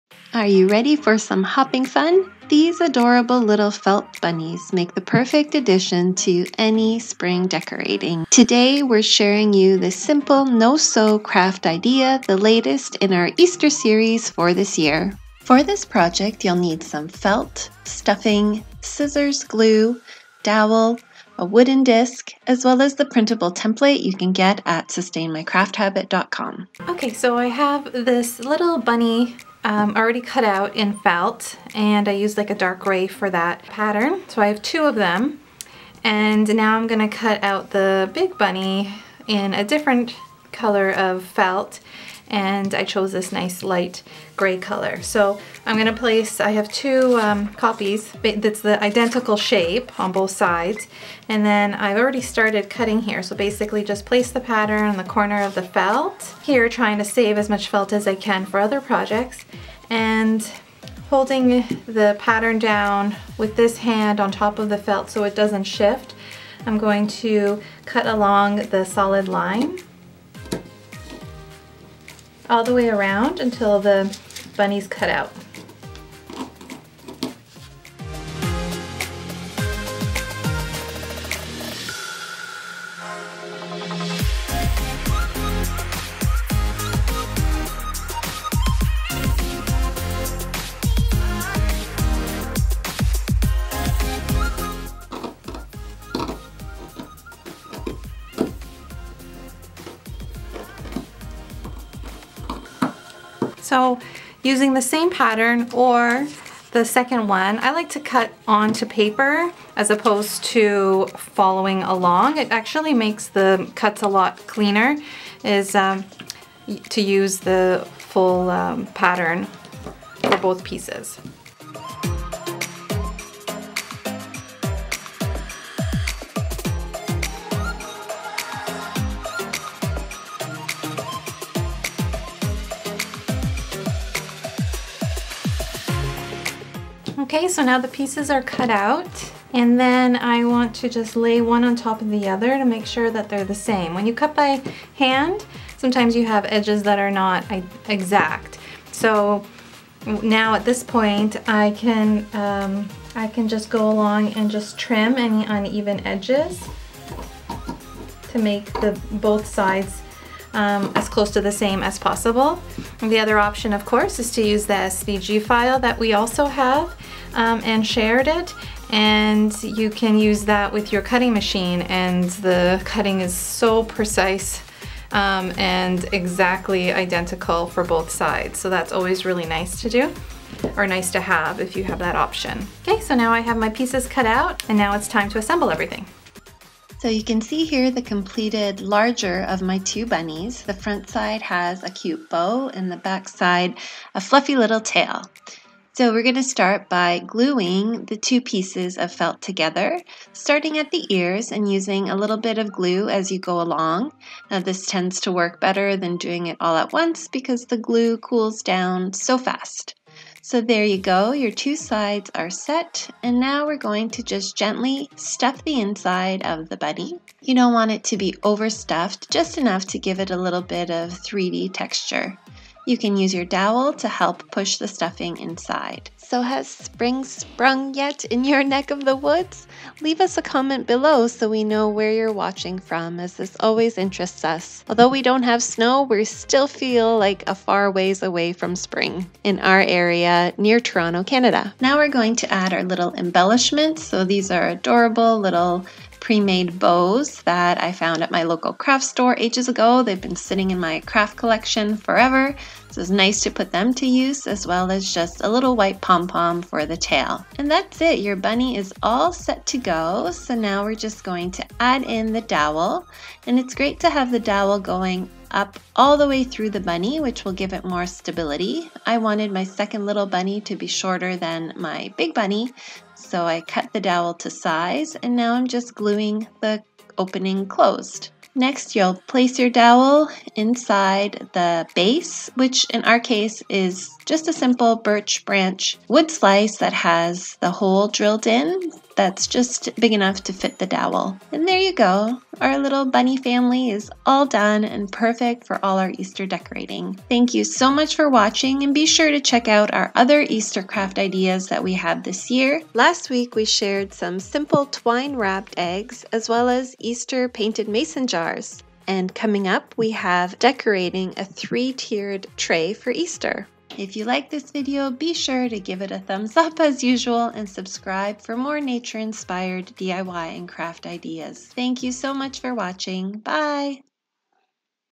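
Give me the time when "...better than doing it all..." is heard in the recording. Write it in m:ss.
3:25.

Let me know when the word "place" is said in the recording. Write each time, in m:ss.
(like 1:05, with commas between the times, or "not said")
0:45, 0:54, 4:39.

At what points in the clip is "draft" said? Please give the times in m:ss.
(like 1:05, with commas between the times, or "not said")
not said.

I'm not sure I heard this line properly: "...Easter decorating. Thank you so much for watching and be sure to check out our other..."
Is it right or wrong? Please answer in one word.
right.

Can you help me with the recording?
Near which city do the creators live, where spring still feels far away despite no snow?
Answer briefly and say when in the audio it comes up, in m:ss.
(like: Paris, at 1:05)
Toronto, at 4:00.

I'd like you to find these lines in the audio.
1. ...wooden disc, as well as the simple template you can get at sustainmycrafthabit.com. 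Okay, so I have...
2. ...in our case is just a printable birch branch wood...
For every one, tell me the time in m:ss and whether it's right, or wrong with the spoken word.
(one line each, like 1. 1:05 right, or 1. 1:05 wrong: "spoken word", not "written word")
1. 0:21 wrong: "printable", not "simple"
2. 4:42 wrong: "simple", not "printable".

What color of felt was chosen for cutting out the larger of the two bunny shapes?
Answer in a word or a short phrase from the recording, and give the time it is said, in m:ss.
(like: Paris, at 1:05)
light gray, at 0:43.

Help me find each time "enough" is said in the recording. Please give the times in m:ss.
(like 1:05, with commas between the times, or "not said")
3:39, 4:50.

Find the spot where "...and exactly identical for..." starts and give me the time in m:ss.
2:55.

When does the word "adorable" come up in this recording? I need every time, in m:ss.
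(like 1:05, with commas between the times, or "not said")
0:02, 4:04.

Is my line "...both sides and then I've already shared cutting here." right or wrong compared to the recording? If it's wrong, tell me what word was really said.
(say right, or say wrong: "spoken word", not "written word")
wrong: "started", not "shared".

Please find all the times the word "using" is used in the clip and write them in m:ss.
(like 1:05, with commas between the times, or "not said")
1:44, 3:21.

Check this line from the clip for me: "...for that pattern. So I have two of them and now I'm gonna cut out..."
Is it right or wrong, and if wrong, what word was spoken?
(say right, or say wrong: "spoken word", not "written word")
right.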